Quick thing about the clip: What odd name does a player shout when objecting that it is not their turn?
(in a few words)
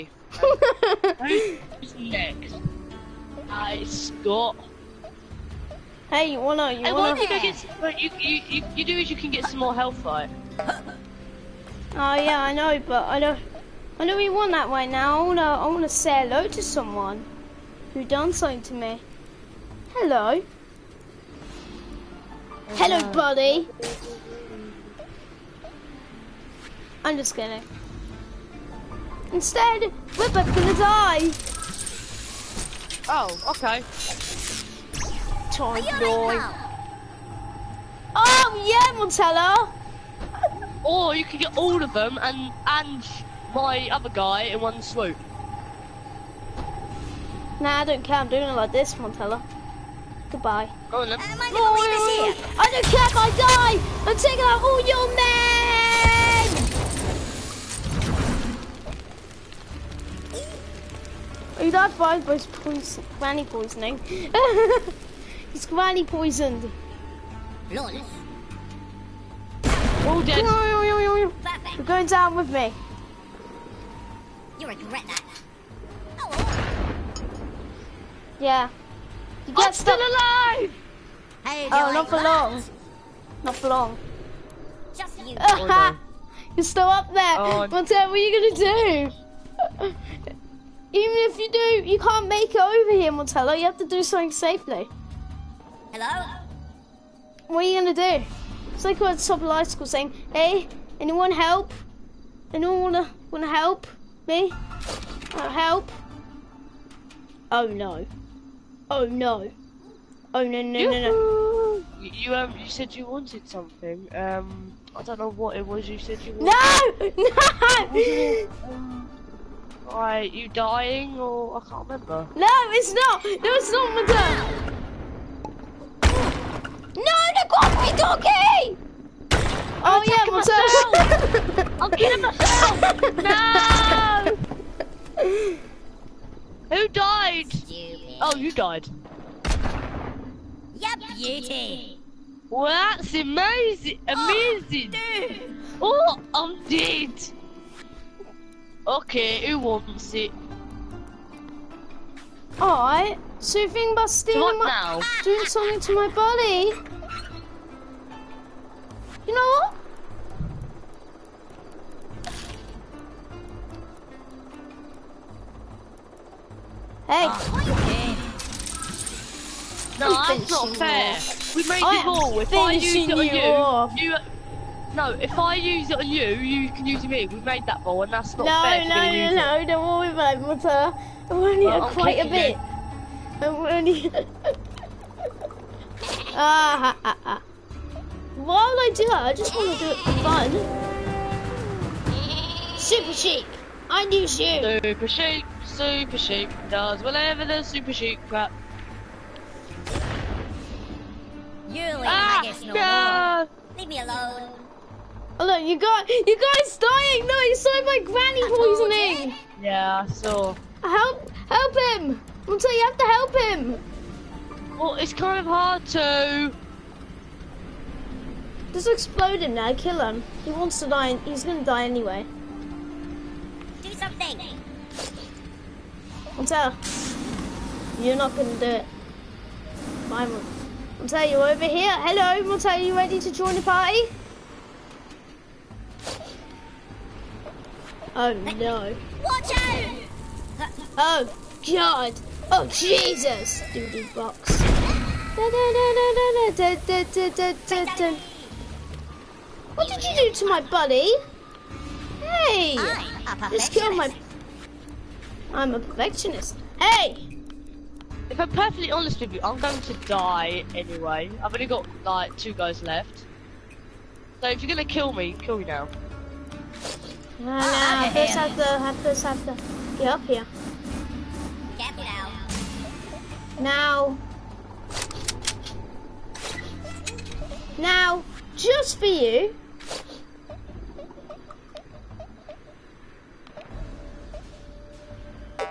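coffee donkey.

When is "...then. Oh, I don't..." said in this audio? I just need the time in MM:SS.
00:51.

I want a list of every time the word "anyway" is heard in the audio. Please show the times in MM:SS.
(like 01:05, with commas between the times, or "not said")
03:41, 04:20.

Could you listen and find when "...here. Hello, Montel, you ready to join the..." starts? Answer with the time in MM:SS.
03:51.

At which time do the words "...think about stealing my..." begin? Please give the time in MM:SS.
02:33.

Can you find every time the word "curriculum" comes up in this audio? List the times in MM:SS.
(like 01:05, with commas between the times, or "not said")
not said.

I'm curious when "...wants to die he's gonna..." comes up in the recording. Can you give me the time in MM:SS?
03:40.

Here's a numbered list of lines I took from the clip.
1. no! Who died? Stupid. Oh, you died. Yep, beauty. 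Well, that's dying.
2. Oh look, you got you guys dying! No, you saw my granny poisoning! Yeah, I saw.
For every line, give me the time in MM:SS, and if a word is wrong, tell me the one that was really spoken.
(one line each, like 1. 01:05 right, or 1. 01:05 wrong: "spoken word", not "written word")
1. 02:15 wrong: "amazing", not "dying"
2. 03:25 right.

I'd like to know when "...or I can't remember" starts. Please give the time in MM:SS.
02:01.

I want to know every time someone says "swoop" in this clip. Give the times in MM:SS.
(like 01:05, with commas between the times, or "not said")
00:44.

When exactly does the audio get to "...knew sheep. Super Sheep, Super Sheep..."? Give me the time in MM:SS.
03:14.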